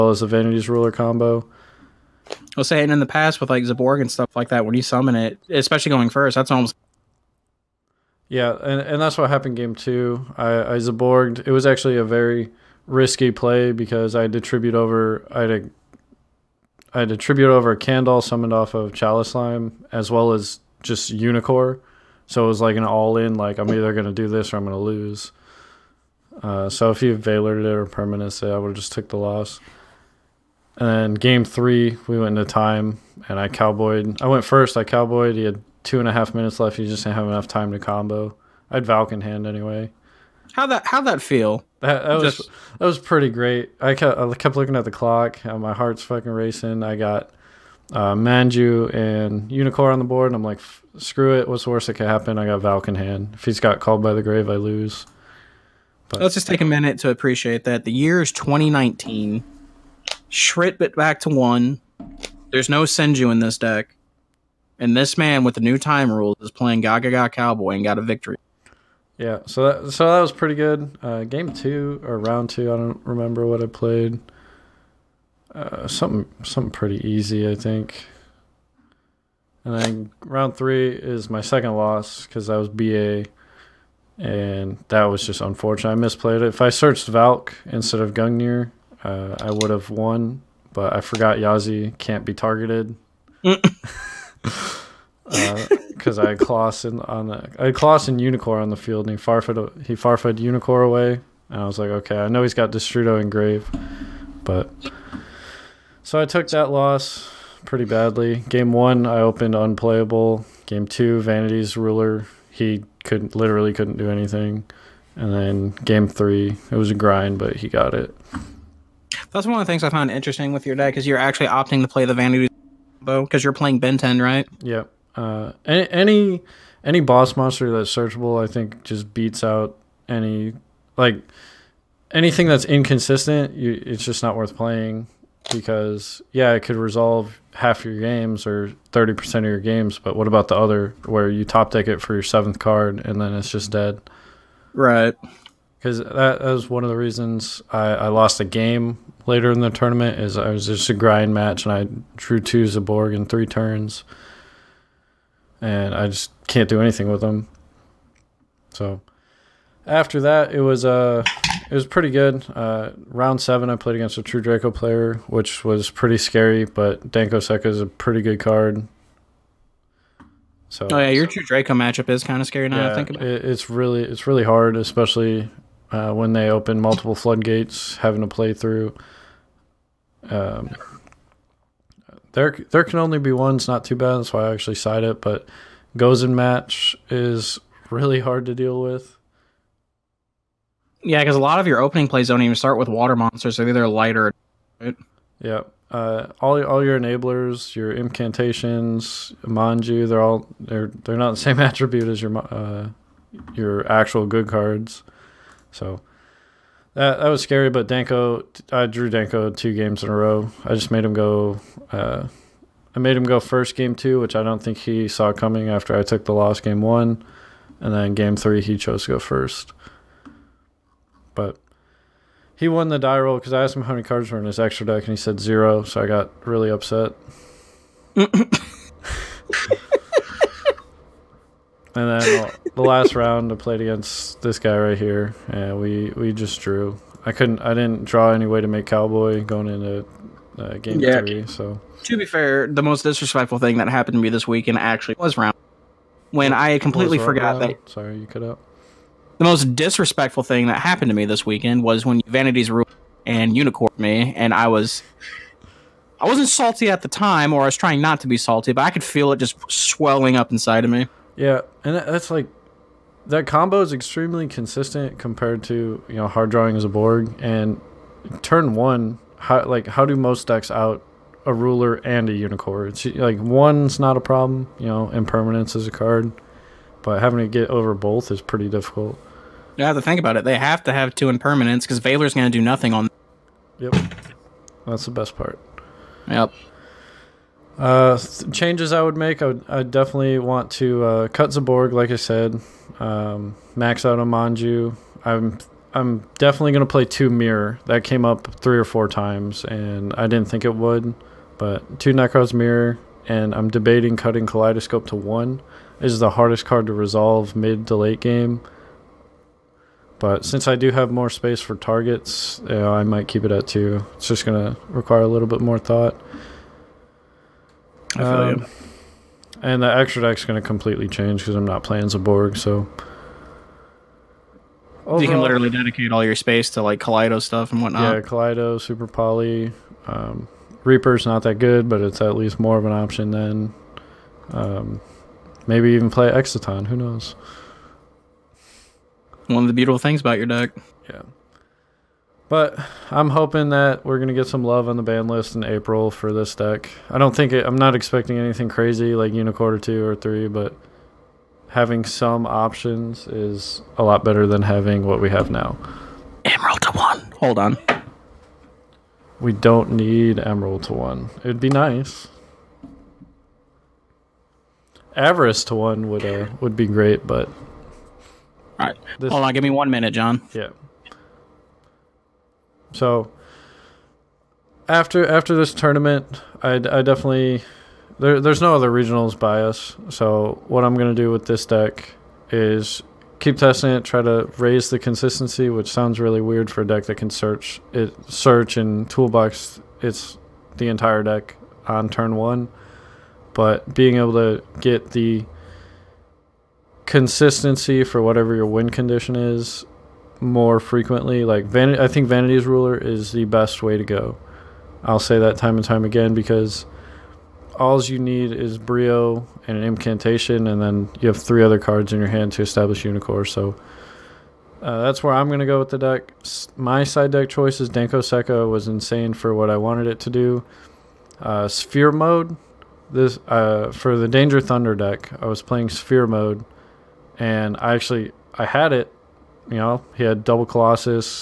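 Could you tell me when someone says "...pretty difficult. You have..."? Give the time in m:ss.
4:38.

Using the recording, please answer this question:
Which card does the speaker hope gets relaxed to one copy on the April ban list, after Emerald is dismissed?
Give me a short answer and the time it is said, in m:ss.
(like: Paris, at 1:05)
Avarice, at 6:05.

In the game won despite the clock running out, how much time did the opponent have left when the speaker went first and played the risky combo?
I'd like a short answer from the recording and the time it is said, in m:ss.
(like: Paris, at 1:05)
2.5 minutes, at 0:35.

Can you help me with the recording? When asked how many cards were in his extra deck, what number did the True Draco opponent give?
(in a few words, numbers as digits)
0.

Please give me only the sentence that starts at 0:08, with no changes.
Yeah, and, and that's what happened game two.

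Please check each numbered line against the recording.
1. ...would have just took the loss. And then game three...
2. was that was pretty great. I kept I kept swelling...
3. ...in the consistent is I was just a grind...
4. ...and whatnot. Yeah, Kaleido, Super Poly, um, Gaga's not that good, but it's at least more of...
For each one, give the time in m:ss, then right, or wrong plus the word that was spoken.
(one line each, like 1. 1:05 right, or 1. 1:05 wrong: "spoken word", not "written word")
1. 0:28 right
2. 0:42 wrong: "looking", not "swelling"
3. 2:29 wrong: "tournament", not "consistent"
4. 5:27 wrong: "Reaper", not "Gaga".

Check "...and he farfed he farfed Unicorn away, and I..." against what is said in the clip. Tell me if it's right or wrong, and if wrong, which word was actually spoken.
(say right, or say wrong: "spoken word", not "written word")
right.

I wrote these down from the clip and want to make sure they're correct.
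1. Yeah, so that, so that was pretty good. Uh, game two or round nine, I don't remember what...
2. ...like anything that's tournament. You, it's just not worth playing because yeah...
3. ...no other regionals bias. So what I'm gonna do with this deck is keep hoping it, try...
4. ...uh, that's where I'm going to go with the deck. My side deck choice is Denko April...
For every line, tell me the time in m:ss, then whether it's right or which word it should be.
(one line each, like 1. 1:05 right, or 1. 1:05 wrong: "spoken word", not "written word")
1. 1:09 wrong: "two", not "nine"
2. 2:10 wrong: "inconsistent", not "tournament"
3. 6:18 wrong: "testing", not "hoping"
4. 6:54 wrong: "Sekka", not "April".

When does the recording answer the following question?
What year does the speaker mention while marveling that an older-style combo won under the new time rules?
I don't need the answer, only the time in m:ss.
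0:58.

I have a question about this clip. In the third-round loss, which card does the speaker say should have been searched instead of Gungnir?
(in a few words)
Valk.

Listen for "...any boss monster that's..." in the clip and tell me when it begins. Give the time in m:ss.
2:06.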